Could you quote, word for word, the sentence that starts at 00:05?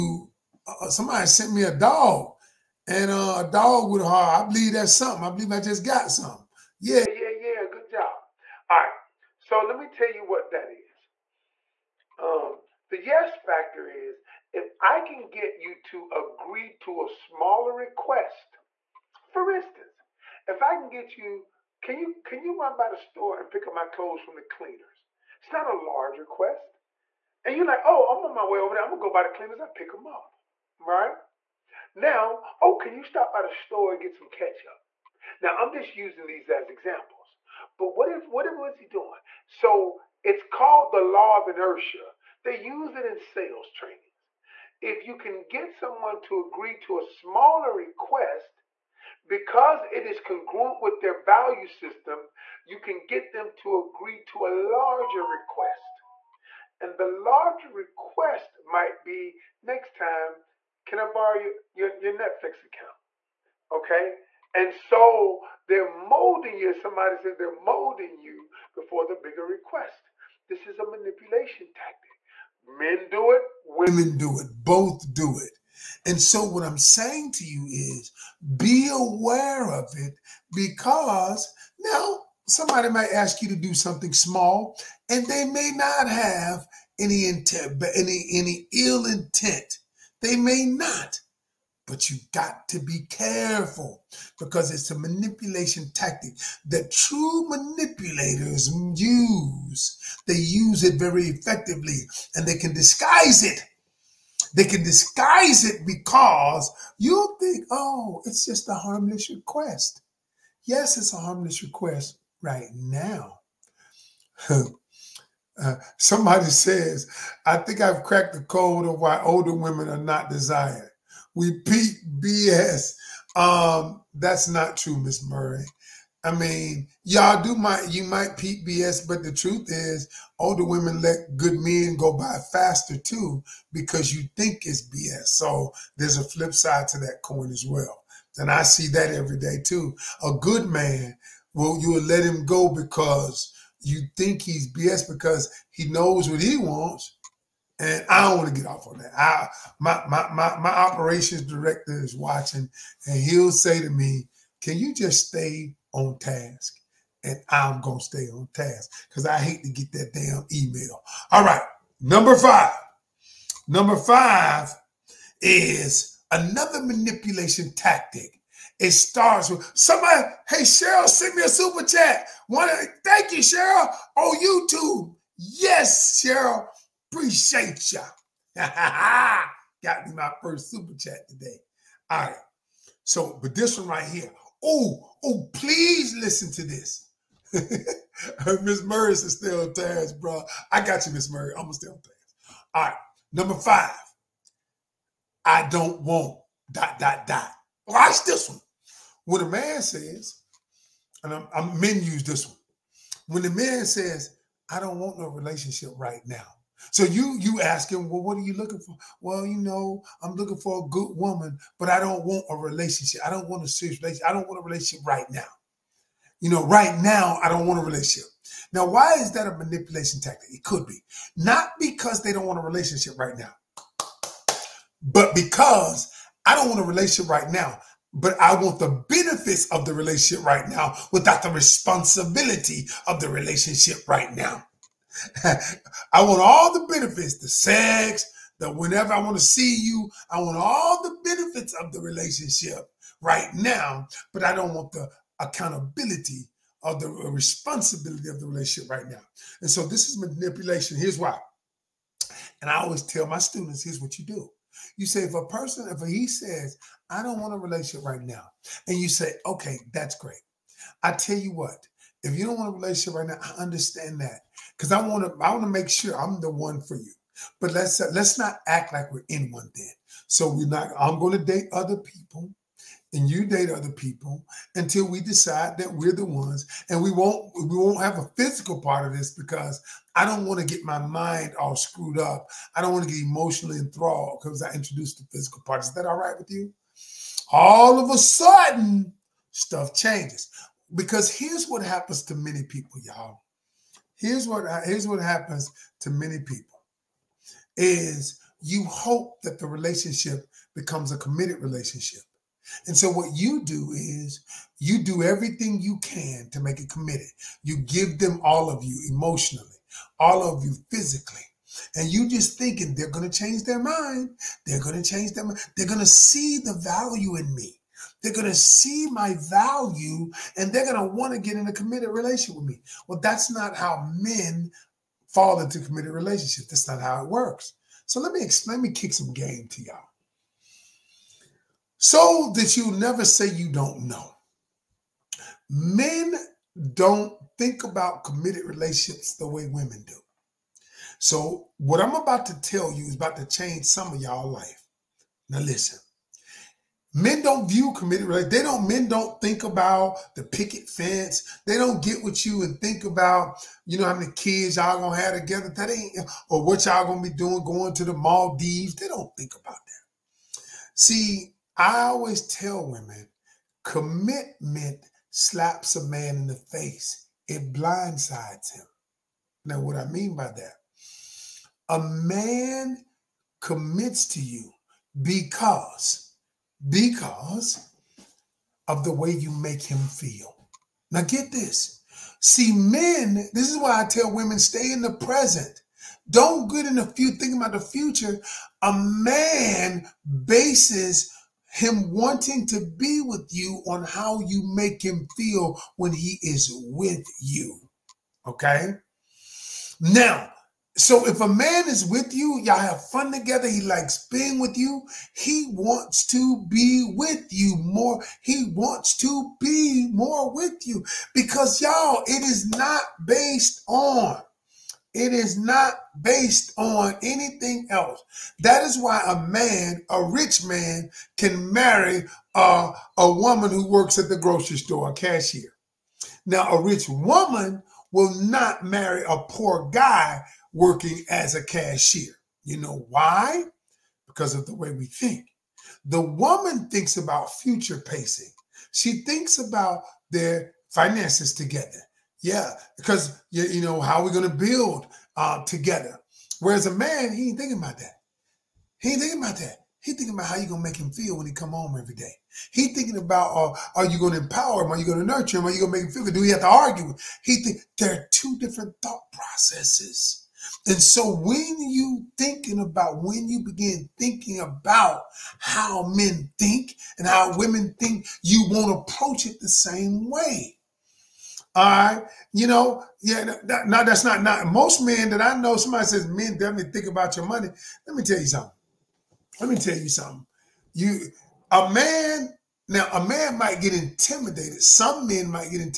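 I believe I just got something.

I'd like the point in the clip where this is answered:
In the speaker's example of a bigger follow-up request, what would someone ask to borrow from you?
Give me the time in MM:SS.
01:02.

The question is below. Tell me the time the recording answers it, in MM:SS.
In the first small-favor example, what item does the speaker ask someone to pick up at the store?
00:34.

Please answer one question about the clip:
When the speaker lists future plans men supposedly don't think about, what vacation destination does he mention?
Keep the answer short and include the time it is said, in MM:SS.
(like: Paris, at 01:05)
Maldives, at 05:58.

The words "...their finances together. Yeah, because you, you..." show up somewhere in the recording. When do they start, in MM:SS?
07:20.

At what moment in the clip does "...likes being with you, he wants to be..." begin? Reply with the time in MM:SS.
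06:43.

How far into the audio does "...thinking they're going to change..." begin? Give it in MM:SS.
05:12.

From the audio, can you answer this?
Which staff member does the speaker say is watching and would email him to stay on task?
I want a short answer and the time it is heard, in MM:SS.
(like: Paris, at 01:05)
Operations director, at 02:30.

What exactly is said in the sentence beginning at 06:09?
Now, what I mean by that, a man commits to you because, because of the way you make him feel.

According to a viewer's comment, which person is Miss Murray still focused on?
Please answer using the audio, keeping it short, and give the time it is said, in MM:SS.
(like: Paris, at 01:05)
Terrence, at 03:09.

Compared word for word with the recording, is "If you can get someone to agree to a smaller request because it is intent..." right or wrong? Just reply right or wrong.
wrong.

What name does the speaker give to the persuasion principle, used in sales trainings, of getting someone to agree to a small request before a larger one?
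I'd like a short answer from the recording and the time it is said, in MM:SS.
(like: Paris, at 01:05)
Law of inertia, at 00:41.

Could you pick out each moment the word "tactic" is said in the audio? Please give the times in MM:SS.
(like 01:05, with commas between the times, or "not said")
01:11, 01:35, 02:47, 03:40.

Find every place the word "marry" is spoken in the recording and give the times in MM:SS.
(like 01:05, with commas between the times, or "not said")
07:01, 07:08.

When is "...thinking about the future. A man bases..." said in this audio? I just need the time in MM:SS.
06:27.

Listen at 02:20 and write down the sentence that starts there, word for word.
A good man well, you'll let him go because you think he's BS because he knows what he wants.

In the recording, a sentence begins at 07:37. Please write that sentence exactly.
He think there are two different thought processes.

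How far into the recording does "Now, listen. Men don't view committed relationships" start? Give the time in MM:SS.
05:45.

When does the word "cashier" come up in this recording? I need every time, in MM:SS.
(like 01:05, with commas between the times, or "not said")
07:05, 07:11.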